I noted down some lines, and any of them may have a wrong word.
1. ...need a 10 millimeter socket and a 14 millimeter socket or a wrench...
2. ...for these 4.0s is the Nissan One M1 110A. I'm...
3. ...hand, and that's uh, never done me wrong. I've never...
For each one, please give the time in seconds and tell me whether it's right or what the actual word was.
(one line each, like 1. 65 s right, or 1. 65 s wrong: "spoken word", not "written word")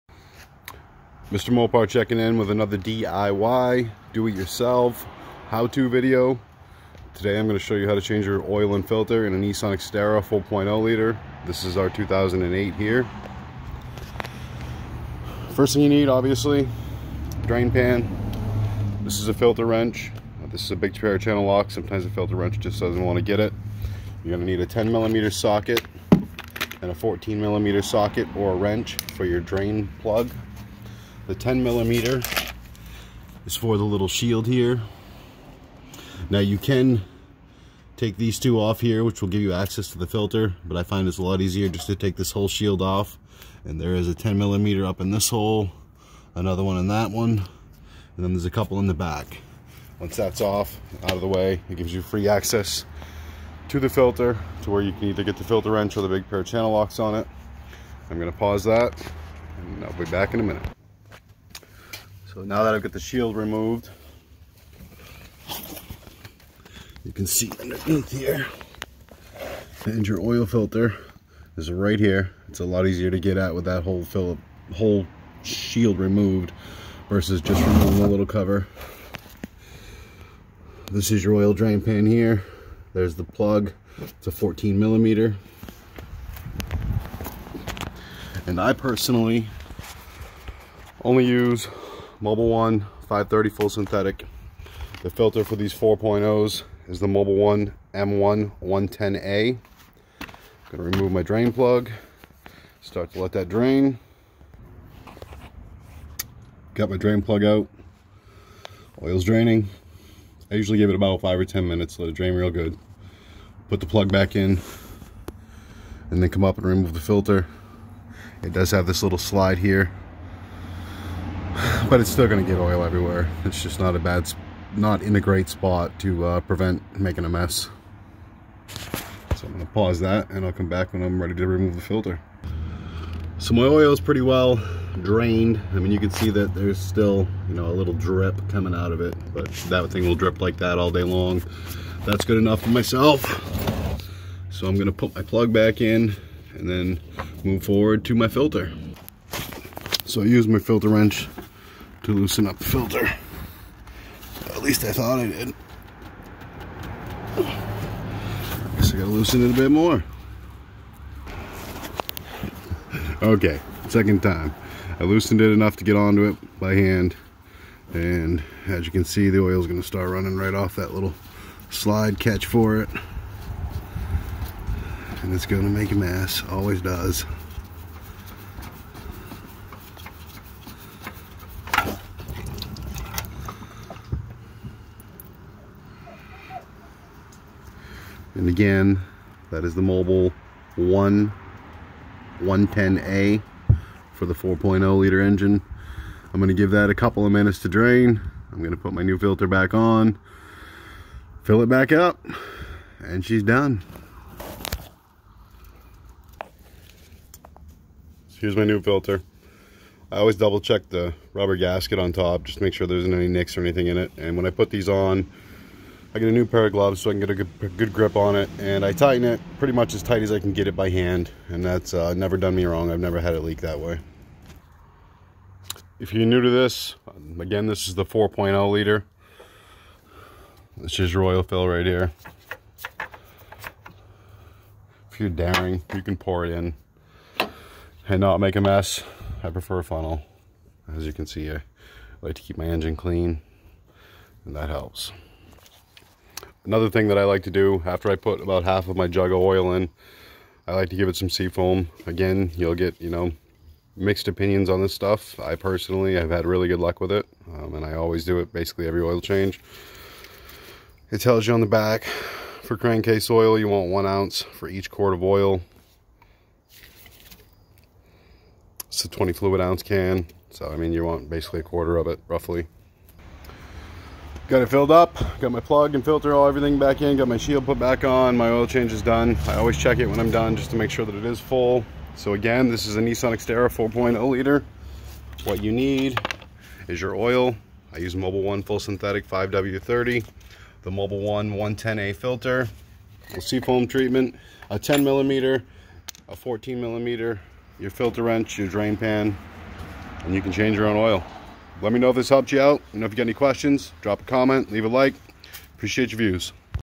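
1. 24 s right
2. 95 s wrong: "Mobil", not "Nissan"
3. 220 s right.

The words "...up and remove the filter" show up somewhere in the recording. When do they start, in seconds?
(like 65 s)
116 s.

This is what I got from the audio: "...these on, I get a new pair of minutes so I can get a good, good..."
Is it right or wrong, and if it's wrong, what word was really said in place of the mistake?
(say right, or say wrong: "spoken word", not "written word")
wrong: "gloves", not "minutes".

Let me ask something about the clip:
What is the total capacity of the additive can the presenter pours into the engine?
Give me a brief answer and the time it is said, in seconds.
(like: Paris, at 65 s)
20 fluid ounces, at 269 s.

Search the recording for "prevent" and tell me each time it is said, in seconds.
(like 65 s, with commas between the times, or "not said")
126 s.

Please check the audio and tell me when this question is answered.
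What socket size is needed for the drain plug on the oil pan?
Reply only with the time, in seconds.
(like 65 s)
83 s.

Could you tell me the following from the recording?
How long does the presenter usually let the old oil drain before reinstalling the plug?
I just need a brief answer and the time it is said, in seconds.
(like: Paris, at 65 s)
5 or 10 minutes, at 111 s.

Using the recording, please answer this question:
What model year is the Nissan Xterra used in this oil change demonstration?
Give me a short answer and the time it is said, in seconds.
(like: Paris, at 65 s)
2008, at 11 s.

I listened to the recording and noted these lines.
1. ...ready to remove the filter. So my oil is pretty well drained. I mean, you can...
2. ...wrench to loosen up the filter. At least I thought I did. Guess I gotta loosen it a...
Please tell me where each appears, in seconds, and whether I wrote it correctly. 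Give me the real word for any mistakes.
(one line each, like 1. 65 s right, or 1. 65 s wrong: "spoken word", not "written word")
1. 131 s right
2. 150 s right.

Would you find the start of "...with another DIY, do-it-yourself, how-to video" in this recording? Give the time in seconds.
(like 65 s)
2 s.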